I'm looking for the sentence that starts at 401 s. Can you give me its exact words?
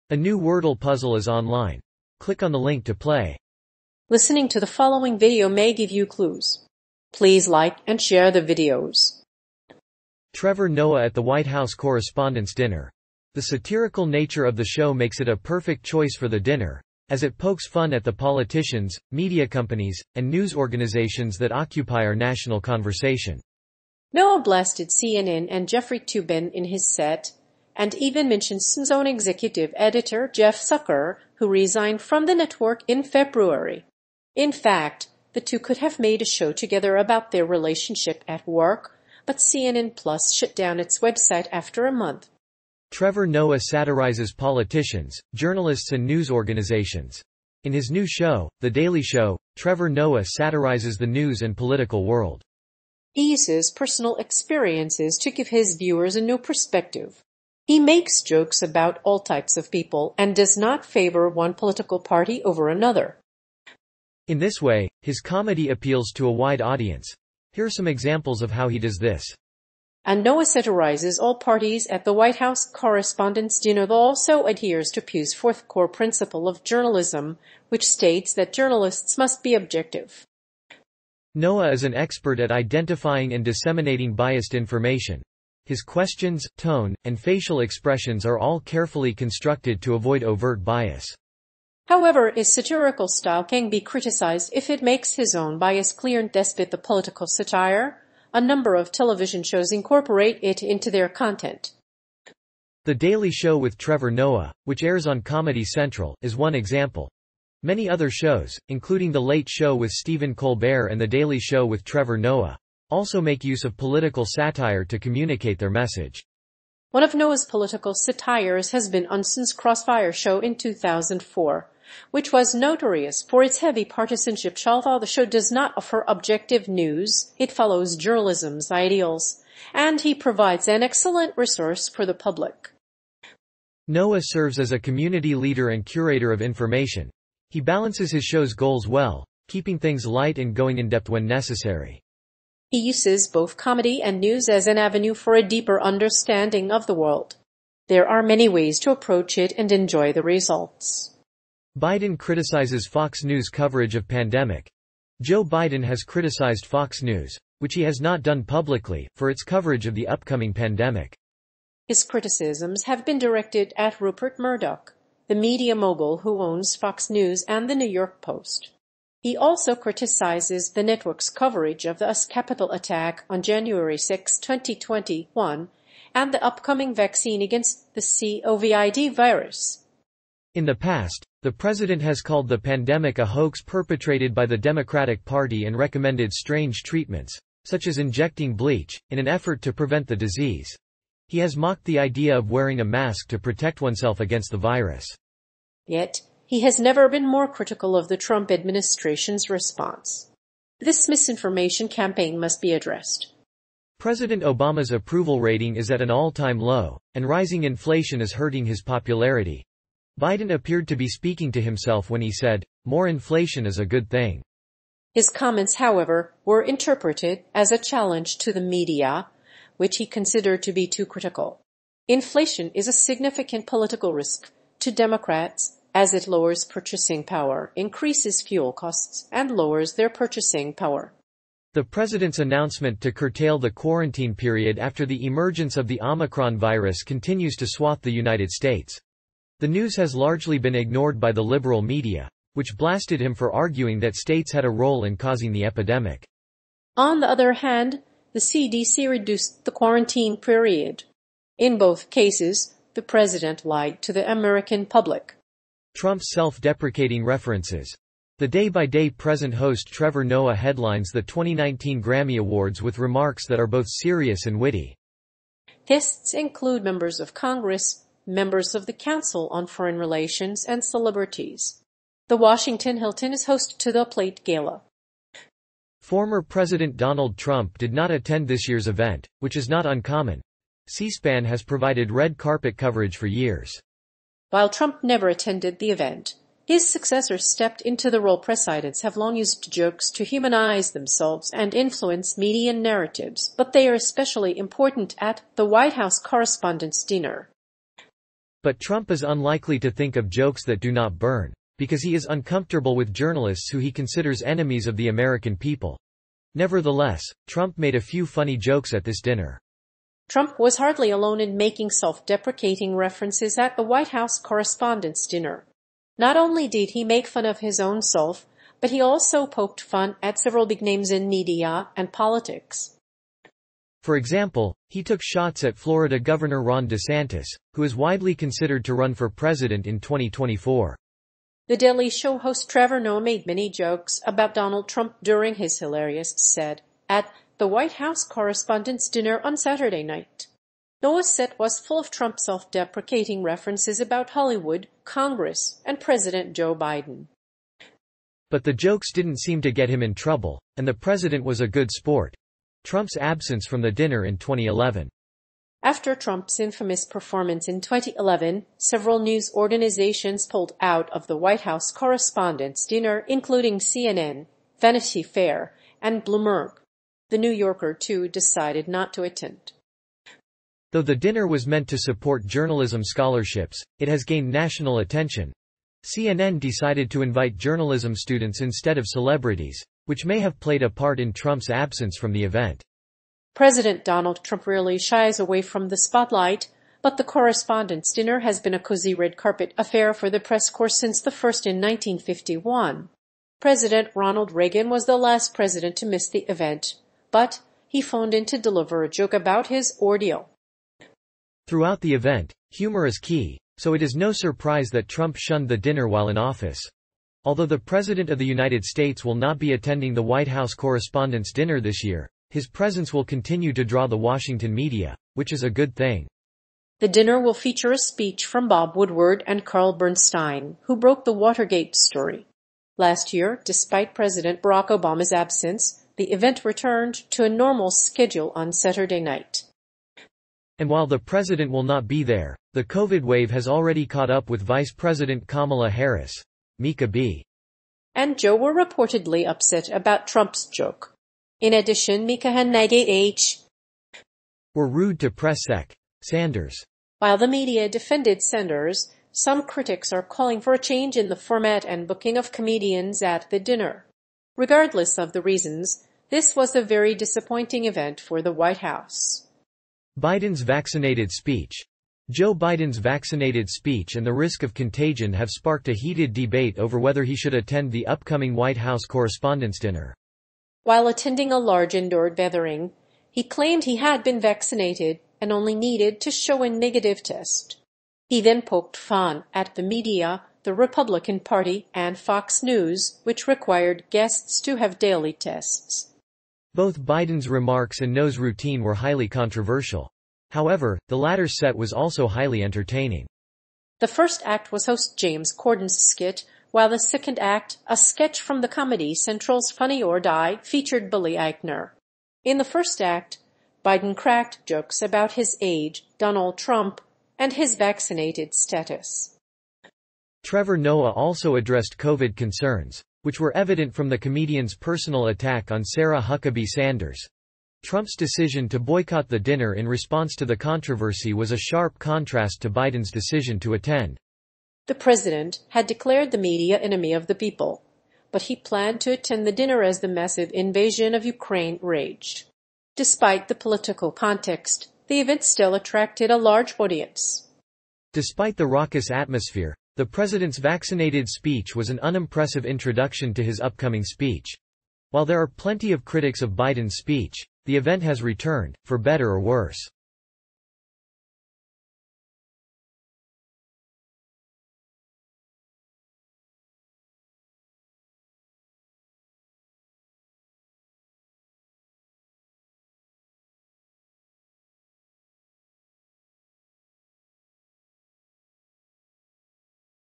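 Throughout the event, humor is key, so it is no surprise that Trump shunned the dinner while in office.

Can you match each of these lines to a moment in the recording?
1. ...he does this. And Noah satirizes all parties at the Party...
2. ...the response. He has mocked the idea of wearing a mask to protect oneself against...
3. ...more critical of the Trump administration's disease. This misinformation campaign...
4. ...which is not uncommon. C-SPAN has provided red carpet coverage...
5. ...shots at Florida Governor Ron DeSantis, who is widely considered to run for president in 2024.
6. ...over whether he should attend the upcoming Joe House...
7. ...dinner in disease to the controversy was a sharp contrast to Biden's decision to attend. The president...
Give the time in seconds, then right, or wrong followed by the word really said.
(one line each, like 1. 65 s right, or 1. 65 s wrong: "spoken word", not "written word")
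1. 68 s wrong: "White", not "Party"
2. 190 s wrong: "disease", not "response"
3. 197 s wrong: "response", not "disease"
4. 279 s right
5. 325 s right
6. 466 s wrong: "White", not "Joe"
7. 519 s wrong: "response", not "disease".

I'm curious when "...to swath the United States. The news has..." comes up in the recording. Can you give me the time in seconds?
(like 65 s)
237 s.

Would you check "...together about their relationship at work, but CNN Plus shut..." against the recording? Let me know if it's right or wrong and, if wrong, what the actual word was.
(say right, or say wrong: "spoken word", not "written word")
right.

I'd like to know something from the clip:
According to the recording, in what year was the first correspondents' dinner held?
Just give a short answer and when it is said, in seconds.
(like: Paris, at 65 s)
1951, at 391 s.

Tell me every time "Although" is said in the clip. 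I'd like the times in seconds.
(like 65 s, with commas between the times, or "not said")
124 s, 407 s.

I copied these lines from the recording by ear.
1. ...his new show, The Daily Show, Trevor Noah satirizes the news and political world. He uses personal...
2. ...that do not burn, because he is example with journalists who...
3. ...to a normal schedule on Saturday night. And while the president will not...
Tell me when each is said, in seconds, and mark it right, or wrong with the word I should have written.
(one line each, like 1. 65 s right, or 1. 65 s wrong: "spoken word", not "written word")
1. 47 s right
2. 300 s wrong: "uncomfortable", not "example"
3. 427 s right.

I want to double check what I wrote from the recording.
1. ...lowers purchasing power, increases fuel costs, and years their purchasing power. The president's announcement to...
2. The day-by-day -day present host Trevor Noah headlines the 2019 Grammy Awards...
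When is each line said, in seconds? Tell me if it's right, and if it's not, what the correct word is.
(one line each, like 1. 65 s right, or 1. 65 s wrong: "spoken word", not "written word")
1. 226 s wrong: "lowers", not "years"
2. 258 s right.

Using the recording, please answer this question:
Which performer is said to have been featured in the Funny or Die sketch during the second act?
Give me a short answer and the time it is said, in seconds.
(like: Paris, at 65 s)
Billy Eichner, at 501 s.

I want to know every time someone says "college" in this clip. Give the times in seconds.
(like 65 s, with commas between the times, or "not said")
not said.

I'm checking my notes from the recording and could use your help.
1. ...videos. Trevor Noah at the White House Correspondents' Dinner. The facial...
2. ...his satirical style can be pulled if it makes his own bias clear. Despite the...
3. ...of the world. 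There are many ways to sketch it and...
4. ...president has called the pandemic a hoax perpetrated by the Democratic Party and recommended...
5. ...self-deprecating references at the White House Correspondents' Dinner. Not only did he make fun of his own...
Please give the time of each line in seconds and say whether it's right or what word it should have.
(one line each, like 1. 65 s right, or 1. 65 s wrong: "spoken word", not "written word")
1. 8 s wrong: "satirical", not "facial"
2. 92 s wrong: "criticized", not "pulled"
3. 146 s wrong: "approach", not "sketch"
4. 181 s right
5. 311 s right.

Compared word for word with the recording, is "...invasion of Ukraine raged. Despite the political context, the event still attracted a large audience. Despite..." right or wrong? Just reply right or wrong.
right.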